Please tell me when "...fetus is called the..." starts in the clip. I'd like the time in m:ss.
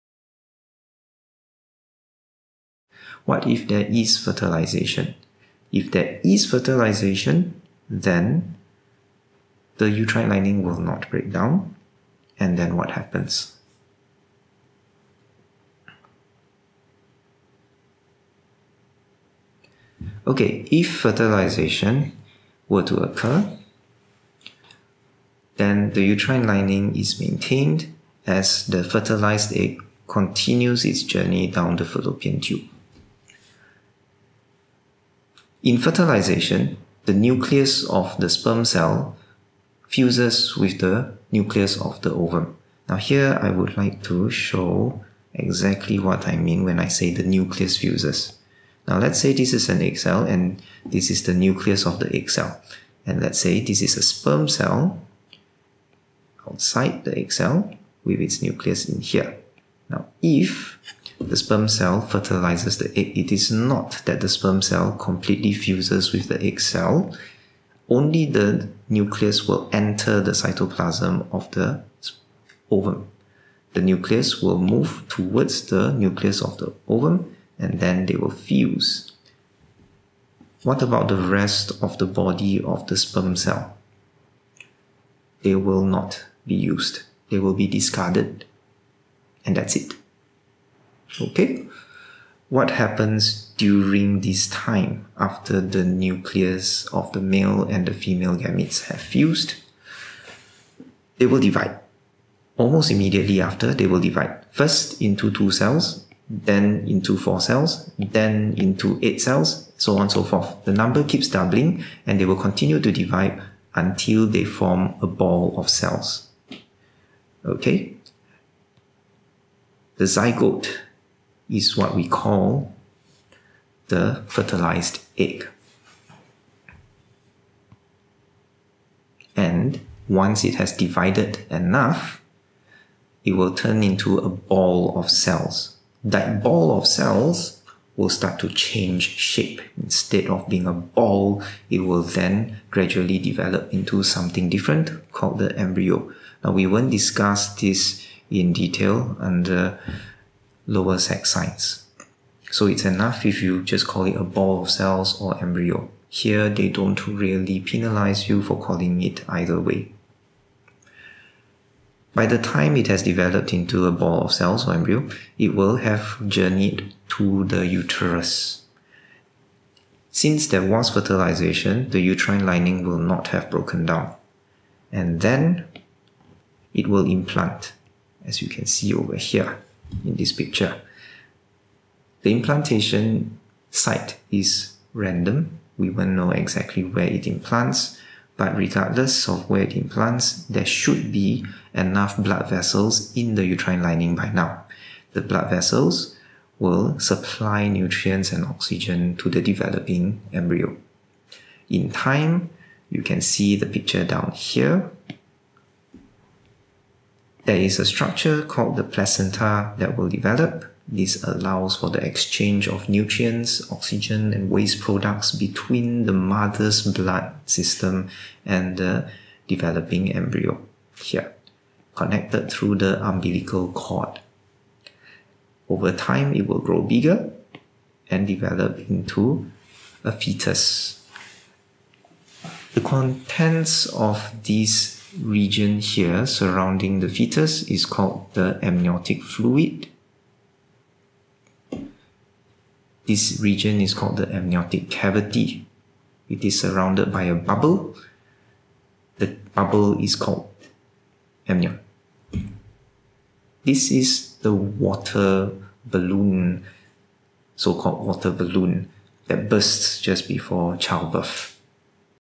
3:57.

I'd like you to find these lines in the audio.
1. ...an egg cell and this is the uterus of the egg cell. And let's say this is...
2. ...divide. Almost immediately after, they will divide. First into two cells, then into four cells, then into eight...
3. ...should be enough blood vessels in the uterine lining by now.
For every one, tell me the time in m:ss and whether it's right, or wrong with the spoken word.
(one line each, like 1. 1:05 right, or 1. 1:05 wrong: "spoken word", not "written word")
1. 0:49 wrong: "nucleus", not "uterus"
2. 1:41 right
3. 3:10 right.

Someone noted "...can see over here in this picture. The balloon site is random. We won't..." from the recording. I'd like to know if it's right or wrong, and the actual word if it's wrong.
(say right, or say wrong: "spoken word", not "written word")
wrong: "implantation", not "balloon".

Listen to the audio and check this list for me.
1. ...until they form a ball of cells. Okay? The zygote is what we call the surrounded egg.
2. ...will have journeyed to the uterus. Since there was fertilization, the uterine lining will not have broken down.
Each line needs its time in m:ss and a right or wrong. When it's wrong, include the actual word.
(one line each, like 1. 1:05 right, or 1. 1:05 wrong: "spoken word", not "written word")
1. 1:53 wrong: "fertilized", not "surrounded"
2. 2:45 right.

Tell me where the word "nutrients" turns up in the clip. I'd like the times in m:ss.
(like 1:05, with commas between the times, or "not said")
3:17, 3:32.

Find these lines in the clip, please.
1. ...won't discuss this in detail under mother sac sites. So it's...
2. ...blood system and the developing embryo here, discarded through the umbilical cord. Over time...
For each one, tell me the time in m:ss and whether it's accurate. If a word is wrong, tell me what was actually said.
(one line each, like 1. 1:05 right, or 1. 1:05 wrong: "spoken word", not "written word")
1. 2:26 wrong: "lower", not "mother"
2. 3:36 wrong: "connected", not "discarded".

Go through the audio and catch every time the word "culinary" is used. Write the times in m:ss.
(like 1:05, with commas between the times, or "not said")
not said.